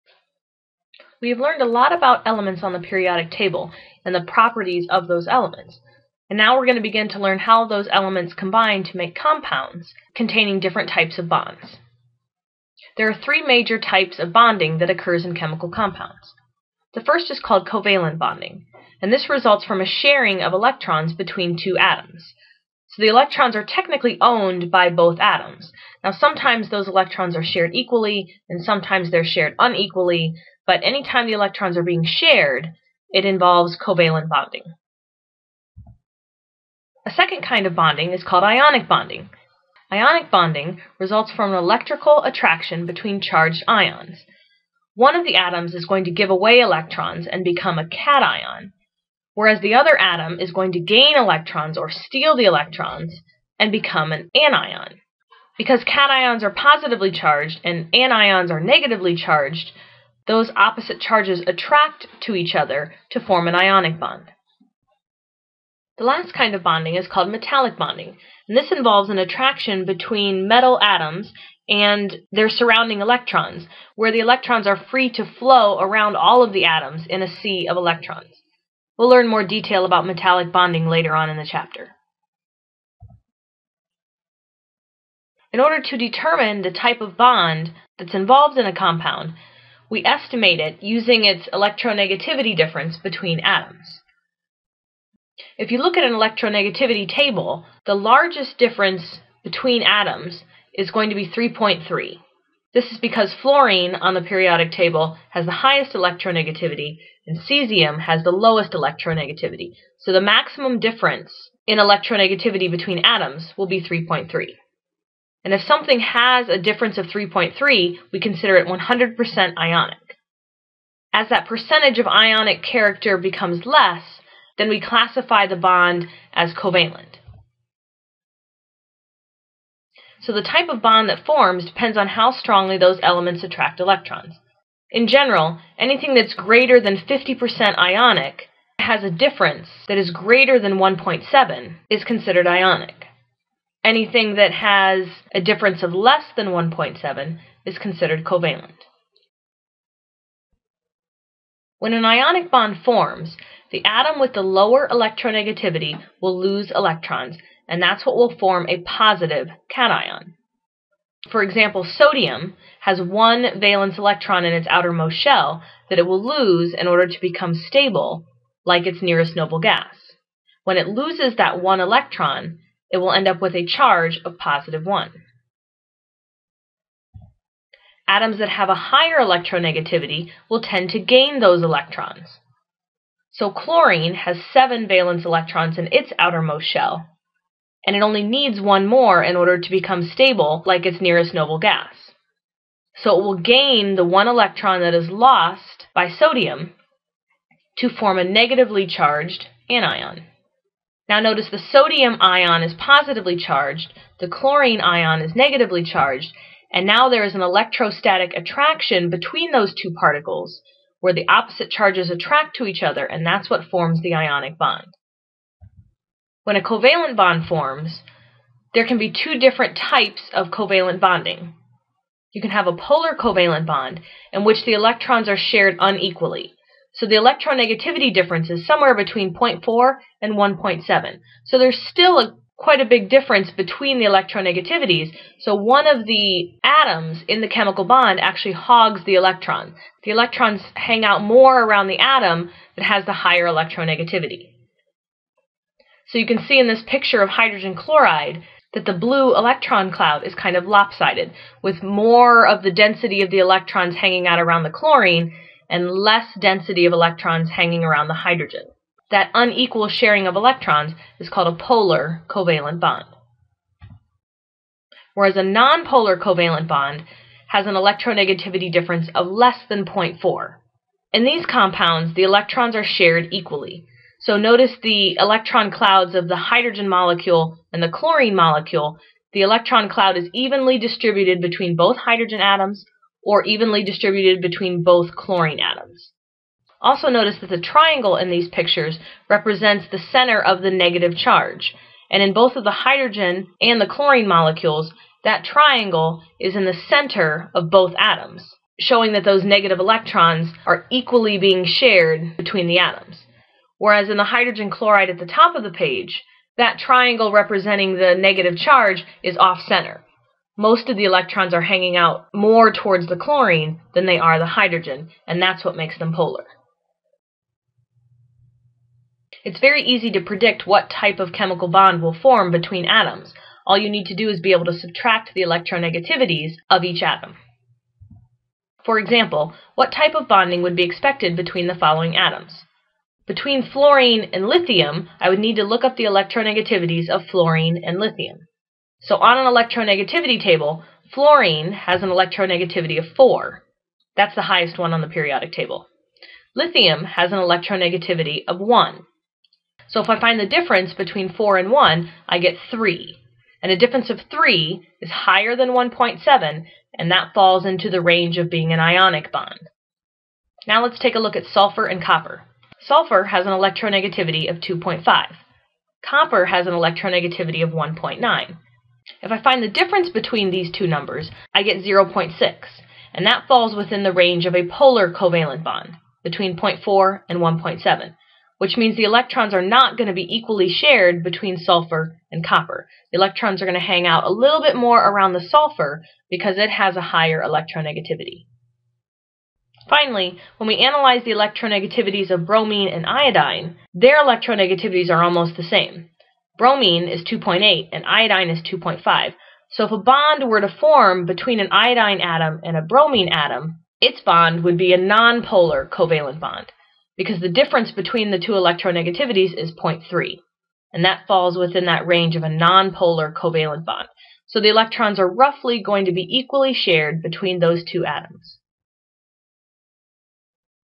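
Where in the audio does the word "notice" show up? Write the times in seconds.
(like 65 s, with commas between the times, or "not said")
201 s, 274 s, 287 s.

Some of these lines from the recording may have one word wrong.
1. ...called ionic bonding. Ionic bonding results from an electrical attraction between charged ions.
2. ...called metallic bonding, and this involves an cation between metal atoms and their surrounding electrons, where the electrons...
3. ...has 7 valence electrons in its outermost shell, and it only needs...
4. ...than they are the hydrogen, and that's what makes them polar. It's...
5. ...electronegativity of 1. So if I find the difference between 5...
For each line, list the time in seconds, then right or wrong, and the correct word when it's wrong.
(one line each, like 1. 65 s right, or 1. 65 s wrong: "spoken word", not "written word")
1. 38 s right
2. 67 s wrong: "attraction", not "cation"
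3. 184 s right
4. 313 s right
5. 347 s wrong: "4", not "5".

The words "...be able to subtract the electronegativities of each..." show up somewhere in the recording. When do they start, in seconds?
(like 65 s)
324 s.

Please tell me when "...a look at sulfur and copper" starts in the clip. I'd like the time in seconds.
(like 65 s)
361 s.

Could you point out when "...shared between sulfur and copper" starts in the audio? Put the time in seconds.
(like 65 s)
380 s.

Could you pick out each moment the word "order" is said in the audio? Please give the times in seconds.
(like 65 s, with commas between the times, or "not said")
85 s, 166 s, 189 s.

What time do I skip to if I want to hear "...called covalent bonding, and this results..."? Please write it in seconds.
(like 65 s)
17 s.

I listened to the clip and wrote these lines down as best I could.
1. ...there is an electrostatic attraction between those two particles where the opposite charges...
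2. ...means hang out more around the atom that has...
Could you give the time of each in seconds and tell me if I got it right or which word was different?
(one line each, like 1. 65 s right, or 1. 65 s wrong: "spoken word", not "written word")
1. 207 s right
2. 240 s wrong: "electrons", not "means".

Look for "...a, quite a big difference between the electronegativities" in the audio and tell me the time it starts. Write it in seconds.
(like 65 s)
232 s.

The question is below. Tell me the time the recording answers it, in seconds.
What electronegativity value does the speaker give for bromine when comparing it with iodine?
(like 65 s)
397 s.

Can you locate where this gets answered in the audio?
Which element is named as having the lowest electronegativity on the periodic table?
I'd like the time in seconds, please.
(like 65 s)
107 s.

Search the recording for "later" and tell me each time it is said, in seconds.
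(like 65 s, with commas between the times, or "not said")
80 s.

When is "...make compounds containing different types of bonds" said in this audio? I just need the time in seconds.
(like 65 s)
8 s.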